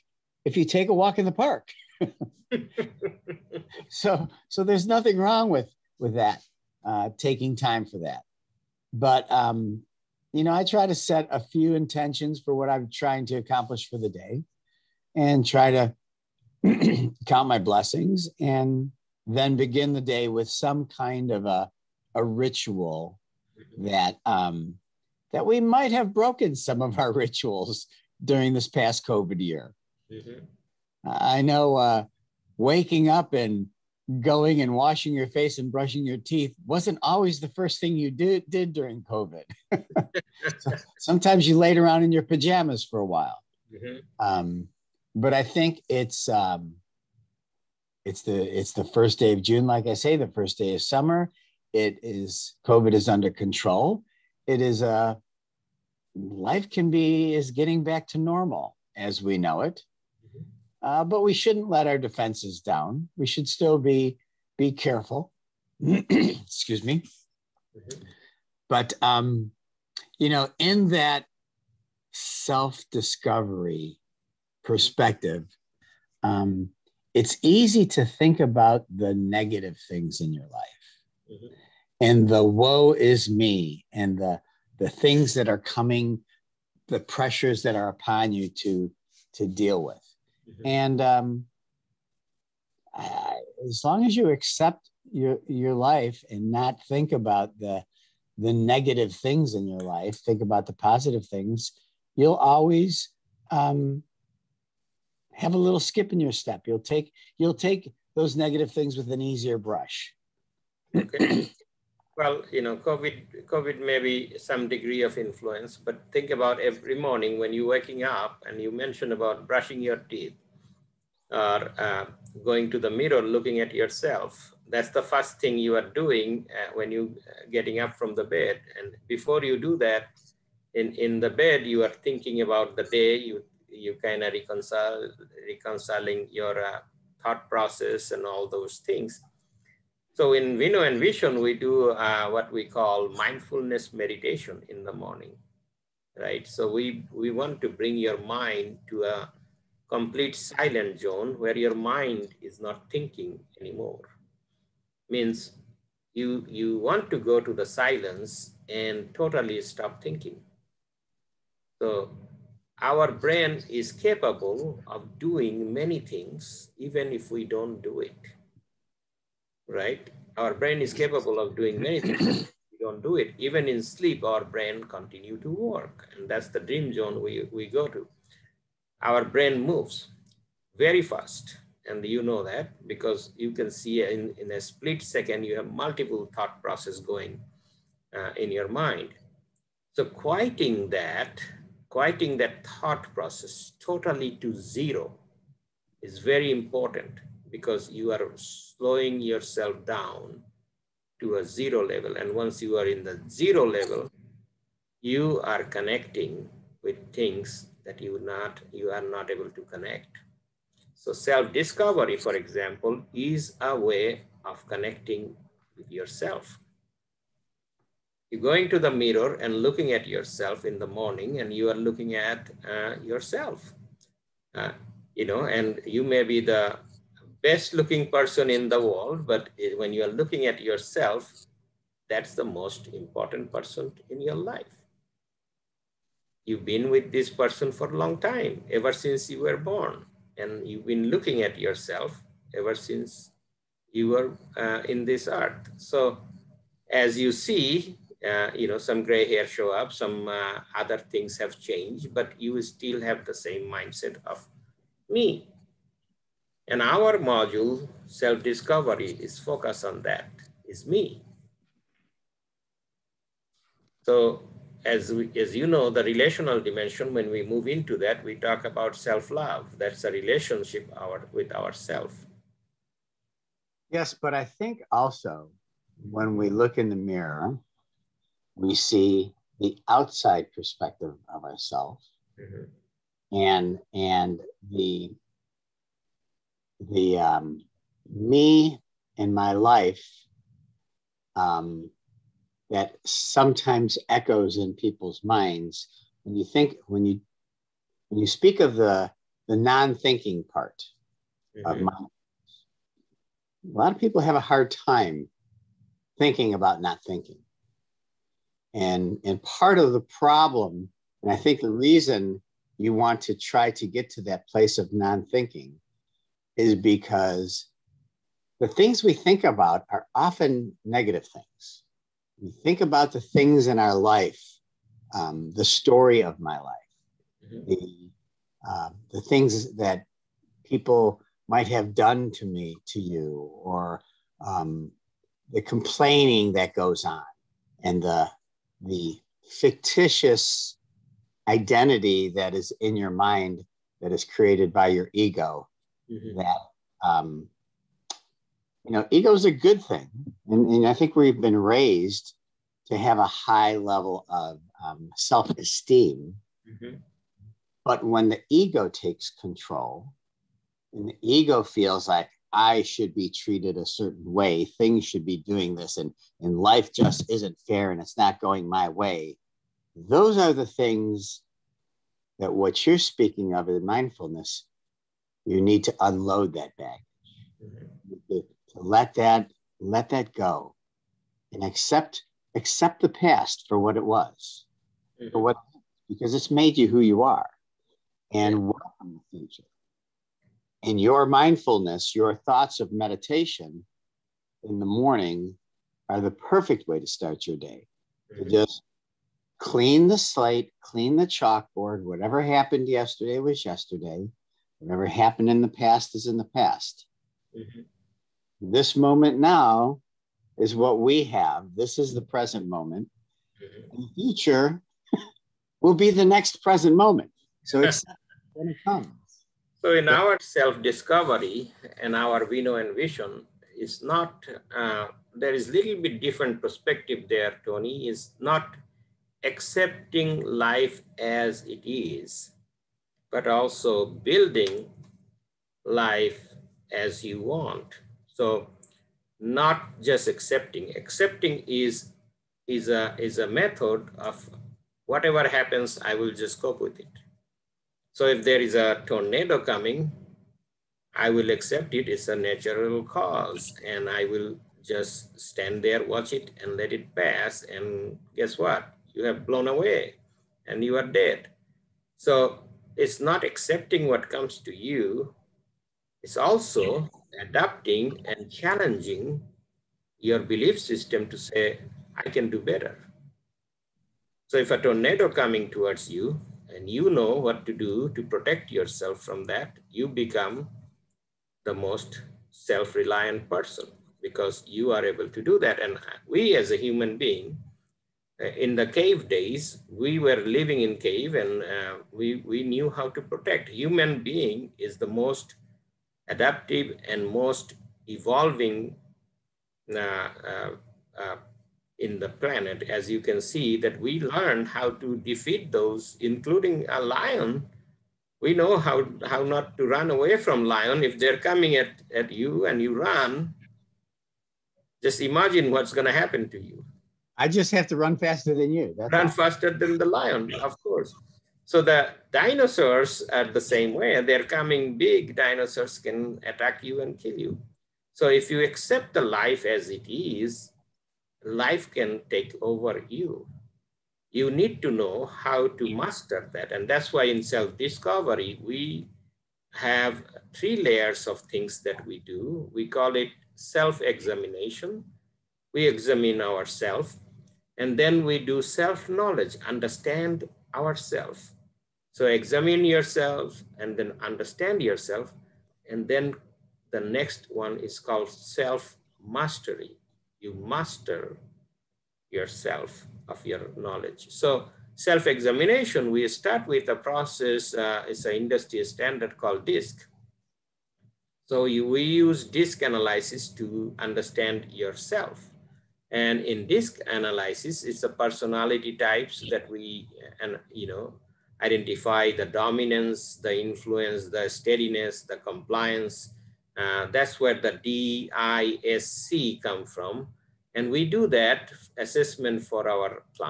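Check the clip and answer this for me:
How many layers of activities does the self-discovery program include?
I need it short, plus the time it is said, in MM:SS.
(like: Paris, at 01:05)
3, at 09:00.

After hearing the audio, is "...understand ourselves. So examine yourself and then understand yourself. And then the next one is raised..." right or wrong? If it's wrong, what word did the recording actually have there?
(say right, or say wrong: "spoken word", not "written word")
wrong: "called", not "raised".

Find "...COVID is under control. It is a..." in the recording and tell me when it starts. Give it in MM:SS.
00:52.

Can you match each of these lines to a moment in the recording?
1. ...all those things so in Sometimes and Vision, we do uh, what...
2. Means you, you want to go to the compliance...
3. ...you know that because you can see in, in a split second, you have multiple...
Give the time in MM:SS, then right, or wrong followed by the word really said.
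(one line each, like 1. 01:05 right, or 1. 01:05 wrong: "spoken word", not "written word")
1. 02:18 wrong: "Vino", not "Sometimes"
2. 02:35 wrong: "silence", not "compliance"
3. 03:02 right.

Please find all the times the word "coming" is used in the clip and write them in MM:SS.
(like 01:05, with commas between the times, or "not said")
01:25, 07:29, 07:55, 08:31, 08:44.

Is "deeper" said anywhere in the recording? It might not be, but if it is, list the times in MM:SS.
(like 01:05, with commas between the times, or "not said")
not said.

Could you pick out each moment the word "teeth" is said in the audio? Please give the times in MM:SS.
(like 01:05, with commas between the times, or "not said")
00:36, 01:59.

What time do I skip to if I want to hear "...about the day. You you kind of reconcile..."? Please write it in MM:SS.
02:12.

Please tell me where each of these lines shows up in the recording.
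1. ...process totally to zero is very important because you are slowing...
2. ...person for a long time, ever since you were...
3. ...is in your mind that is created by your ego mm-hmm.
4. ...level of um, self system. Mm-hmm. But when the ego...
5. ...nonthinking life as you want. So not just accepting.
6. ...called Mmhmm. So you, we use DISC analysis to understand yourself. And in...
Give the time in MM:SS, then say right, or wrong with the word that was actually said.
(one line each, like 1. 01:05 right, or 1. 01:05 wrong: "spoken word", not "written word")
1. 03:13 right
2. 03:57 right
3. 05:42 right
4. 05:53 wrong: "esteem", not "system"
5. 07:14 wrong: "building", not "nonthinking"
6. 09:29 wrong: "DISC", not "Mmhmm".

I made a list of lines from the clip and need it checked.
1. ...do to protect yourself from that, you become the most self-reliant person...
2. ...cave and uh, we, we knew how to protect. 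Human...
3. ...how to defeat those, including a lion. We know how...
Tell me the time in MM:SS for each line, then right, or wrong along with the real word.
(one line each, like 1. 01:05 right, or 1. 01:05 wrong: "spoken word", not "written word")
1. 07:57 right
2. 08:10 right
3. 08:24 right.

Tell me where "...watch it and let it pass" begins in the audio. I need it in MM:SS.
07:36.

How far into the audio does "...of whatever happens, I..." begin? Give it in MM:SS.
07:24.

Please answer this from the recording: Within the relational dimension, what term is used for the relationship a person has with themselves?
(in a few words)
self-love.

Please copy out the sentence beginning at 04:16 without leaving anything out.
And our module, self-discovery, is focused on that, is me.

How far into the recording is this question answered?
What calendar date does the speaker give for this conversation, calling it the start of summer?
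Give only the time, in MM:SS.
00:48.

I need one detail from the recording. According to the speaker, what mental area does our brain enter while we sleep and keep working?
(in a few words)
dream zone.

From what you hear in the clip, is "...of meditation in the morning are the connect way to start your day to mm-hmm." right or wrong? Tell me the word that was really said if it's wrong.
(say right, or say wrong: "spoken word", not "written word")
wrong: "perfect", not "connect".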